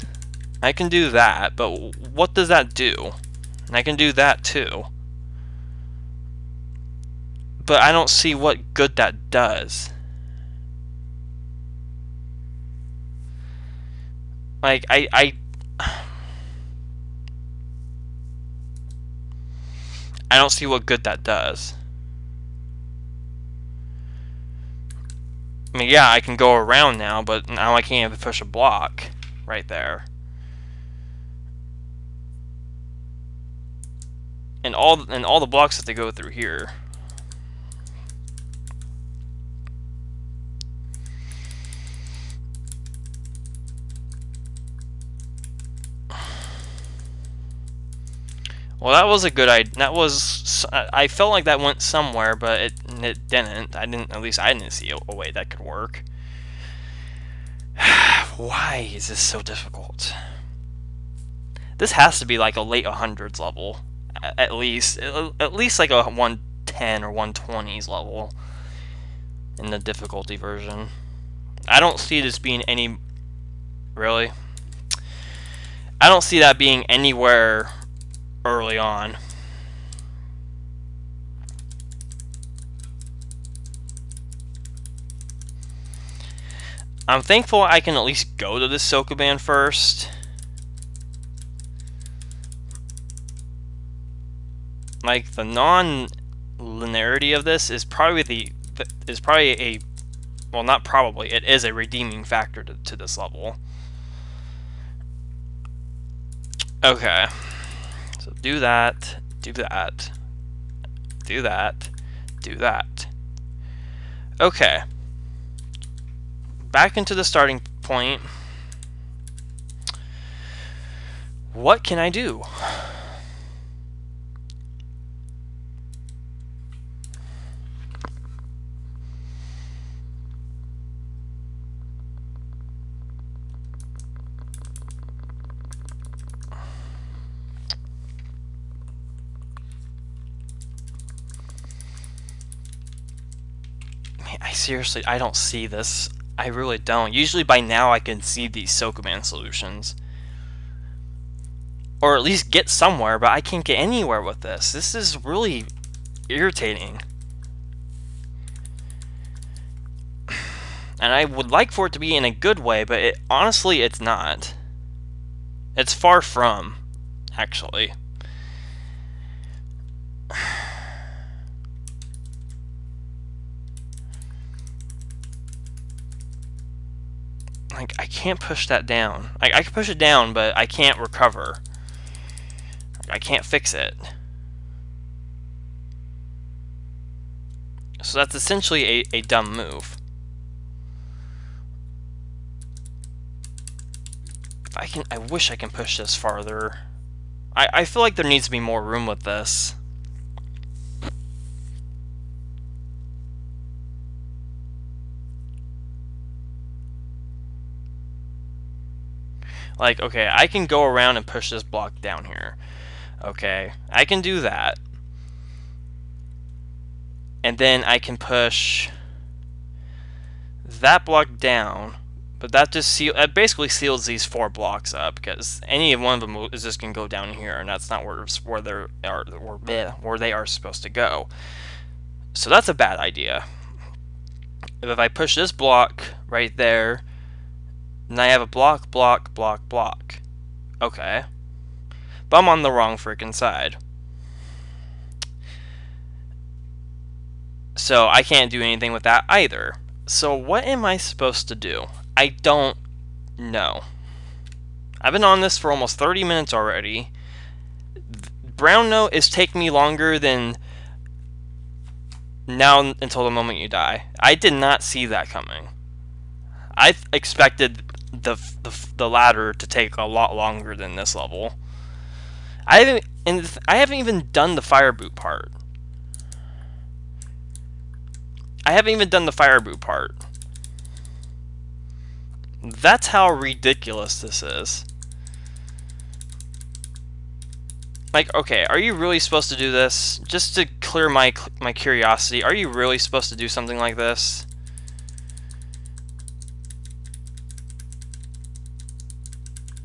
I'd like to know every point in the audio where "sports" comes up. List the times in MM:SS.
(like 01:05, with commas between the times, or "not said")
not said.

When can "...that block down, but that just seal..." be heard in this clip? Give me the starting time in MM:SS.
03:40.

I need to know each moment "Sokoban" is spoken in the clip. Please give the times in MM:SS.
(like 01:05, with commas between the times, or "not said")
01:28, 02:28.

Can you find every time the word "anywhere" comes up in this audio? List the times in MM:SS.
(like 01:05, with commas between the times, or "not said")
01:16, 02:33.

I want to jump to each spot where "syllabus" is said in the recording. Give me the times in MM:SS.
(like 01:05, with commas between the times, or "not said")
not said.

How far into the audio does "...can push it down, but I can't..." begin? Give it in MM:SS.
02:59.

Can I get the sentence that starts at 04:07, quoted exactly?
So I can't do anything with that either.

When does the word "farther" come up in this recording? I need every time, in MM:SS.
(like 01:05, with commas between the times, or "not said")
03:16.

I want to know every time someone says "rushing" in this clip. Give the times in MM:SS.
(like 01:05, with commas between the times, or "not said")
not said.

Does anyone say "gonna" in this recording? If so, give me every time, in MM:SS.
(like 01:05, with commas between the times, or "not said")
03:46.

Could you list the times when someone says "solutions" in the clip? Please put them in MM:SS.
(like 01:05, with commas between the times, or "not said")
02:29.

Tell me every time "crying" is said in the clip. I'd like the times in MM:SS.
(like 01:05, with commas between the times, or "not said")
not said.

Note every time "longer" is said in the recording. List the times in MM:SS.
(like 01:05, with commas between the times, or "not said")
04:19, 04:30.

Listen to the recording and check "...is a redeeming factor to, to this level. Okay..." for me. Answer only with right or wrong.
right.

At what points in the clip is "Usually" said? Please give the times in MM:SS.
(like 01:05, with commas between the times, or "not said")
02:27.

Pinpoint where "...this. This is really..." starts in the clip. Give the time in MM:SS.
02:34.